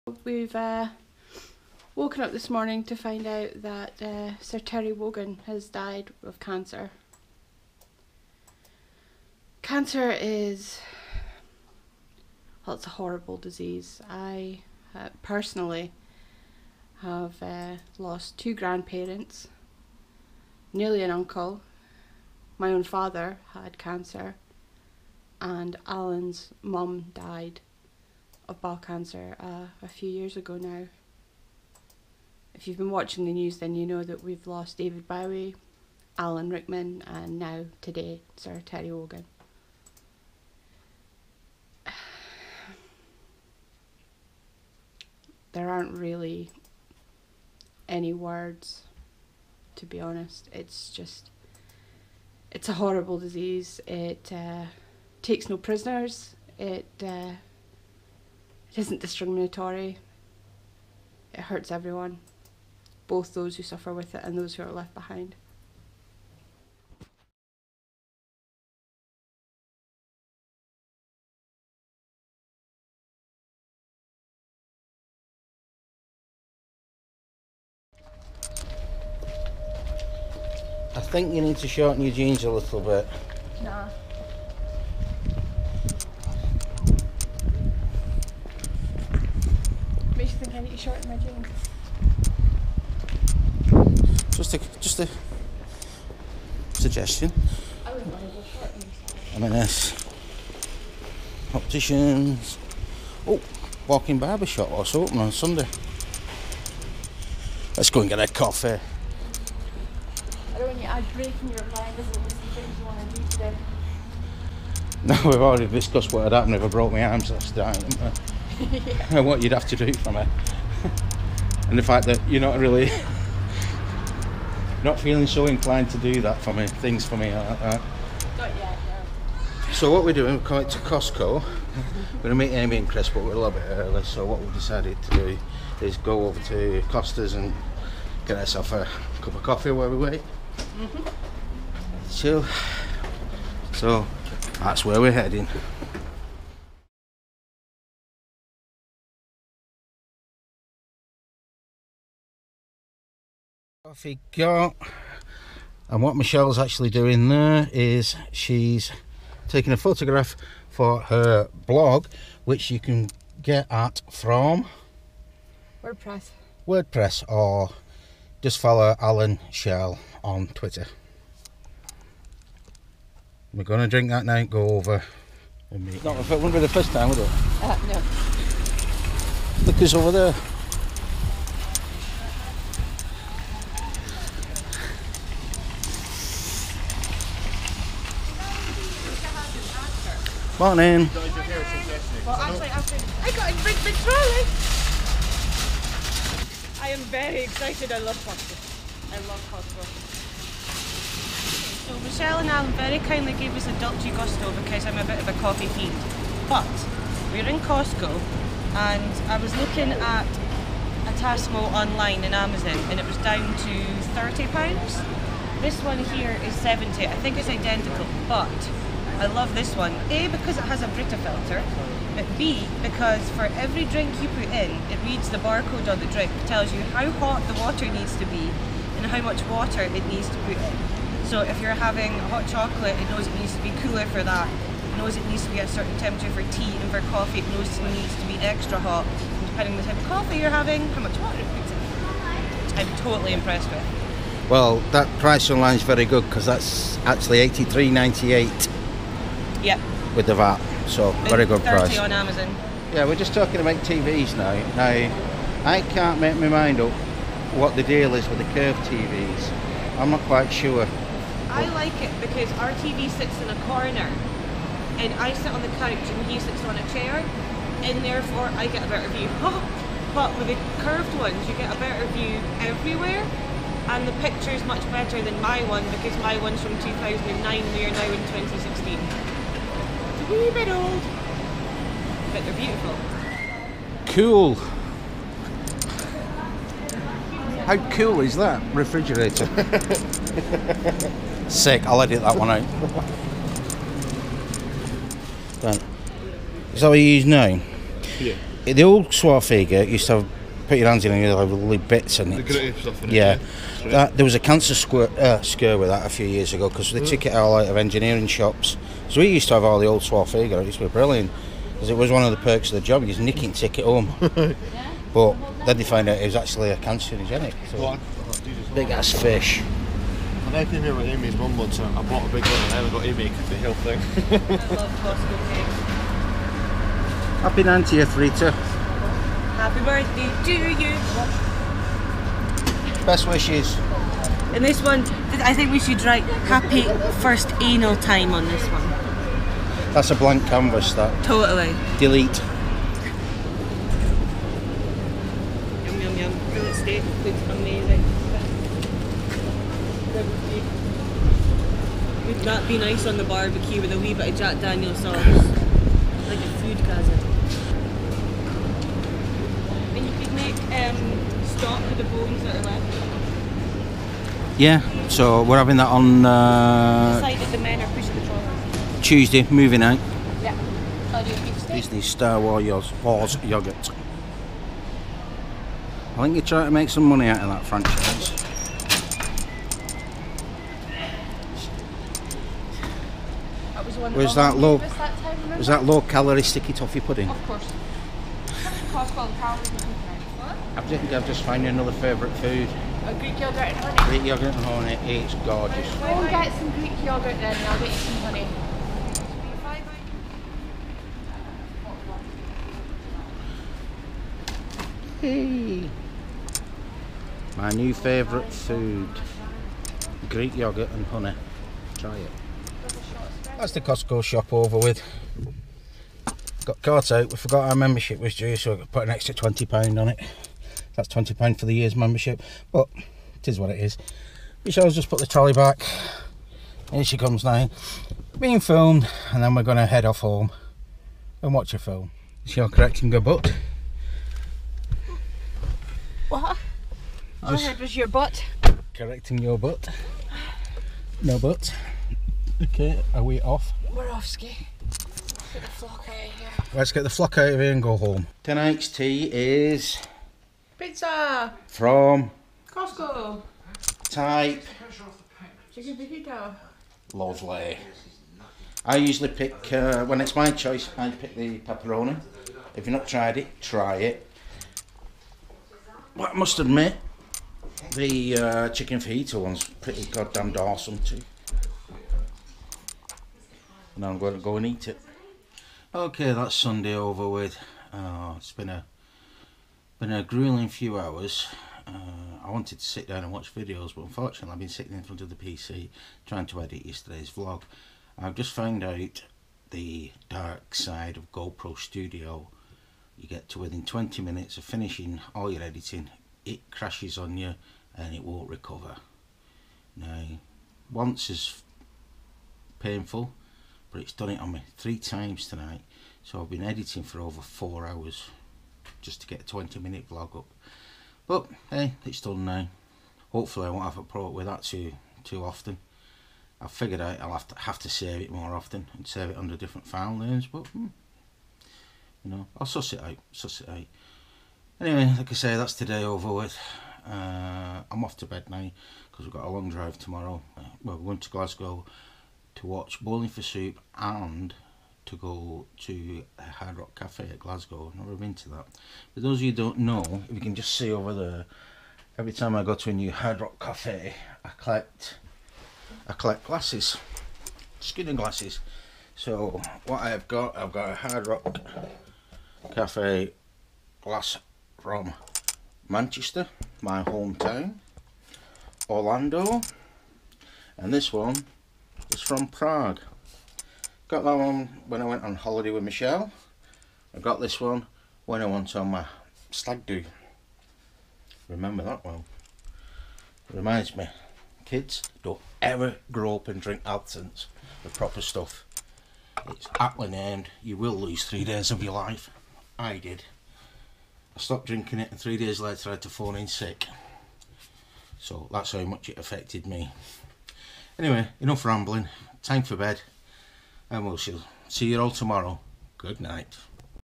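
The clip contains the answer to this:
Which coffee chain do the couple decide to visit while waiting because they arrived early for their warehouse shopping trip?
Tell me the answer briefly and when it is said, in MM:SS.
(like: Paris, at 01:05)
Costa, at 02:16.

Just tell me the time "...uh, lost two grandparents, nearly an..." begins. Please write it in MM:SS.
00:17.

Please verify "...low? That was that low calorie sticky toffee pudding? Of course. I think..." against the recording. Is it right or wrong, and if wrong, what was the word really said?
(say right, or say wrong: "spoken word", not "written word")
right.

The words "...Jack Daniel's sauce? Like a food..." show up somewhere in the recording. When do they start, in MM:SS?
05:54.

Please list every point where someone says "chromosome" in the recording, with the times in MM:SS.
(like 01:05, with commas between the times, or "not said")
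not said.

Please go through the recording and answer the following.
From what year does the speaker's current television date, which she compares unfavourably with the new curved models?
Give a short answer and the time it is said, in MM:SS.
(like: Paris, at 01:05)
2009, at 04:36.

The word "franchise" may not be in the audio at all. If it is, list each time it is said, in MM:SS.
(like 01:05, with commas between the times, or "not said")
06:17.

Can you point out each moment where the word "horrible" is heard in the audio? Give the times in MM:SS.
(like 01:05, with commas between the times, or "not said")
00:12, 00:52.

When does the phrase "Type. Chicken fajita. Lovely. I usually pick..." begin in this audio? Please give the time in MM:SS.
07:34.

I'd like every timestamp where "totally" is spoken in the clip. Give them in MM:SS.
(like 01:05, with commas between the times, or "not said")
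04:02, 05:41.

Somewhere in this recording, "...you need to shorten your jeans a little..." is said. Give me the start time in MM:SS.
01:21.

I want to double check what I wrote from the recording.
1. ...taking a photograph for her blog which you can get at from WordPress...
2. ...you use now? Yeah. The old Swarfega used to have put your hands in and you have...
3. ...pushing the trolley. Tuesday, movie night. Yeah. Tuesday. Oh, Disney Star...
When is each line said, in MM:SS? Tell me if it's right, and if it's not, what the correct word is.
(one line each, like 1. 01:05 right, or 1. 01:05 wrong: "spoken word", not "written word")
1. 02:39 right
2. 04:56 right
3. 06:07 right.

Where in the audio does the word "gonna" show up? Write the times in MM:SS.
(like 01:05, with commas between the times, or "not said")
02:12, 02:53.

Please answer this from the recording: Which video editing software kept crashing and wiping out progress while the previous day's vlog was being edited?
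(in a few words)
GoPro Studio.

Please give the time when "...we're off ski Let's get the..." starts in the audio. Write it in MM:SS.
07:23.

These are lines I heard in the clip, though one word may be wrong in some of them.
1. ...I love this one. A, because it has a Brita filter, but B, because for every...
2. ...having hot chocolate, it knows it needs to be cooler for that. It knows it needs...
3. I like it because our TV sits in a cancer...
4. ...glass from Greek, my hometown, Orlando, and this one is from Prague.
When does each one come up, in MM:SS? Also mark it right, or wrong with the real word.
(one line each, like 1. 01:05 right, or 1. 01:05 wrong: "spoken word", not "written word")
1. 03:39 right
2. 03:51 right
3. 04:21 wrong: "corner", not "cancer"
4. 09:14 wrong: "Manchester", not "Greek".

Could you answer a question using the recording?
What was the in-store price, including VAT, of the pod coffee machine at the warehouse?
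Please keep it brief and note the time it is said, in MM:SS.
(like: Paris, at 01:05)
83.98, at 04:07.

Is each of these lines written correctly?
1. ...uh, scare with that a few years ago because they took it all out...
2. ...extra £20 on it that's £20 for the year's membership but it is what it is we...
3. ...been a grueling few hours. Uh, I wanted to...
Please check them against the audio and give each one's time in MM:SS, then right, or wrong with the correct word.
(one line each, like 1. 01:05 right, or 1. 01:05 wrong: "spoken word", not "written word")
1. 05:05 right
2. 06:59 right
3. 08:00 right.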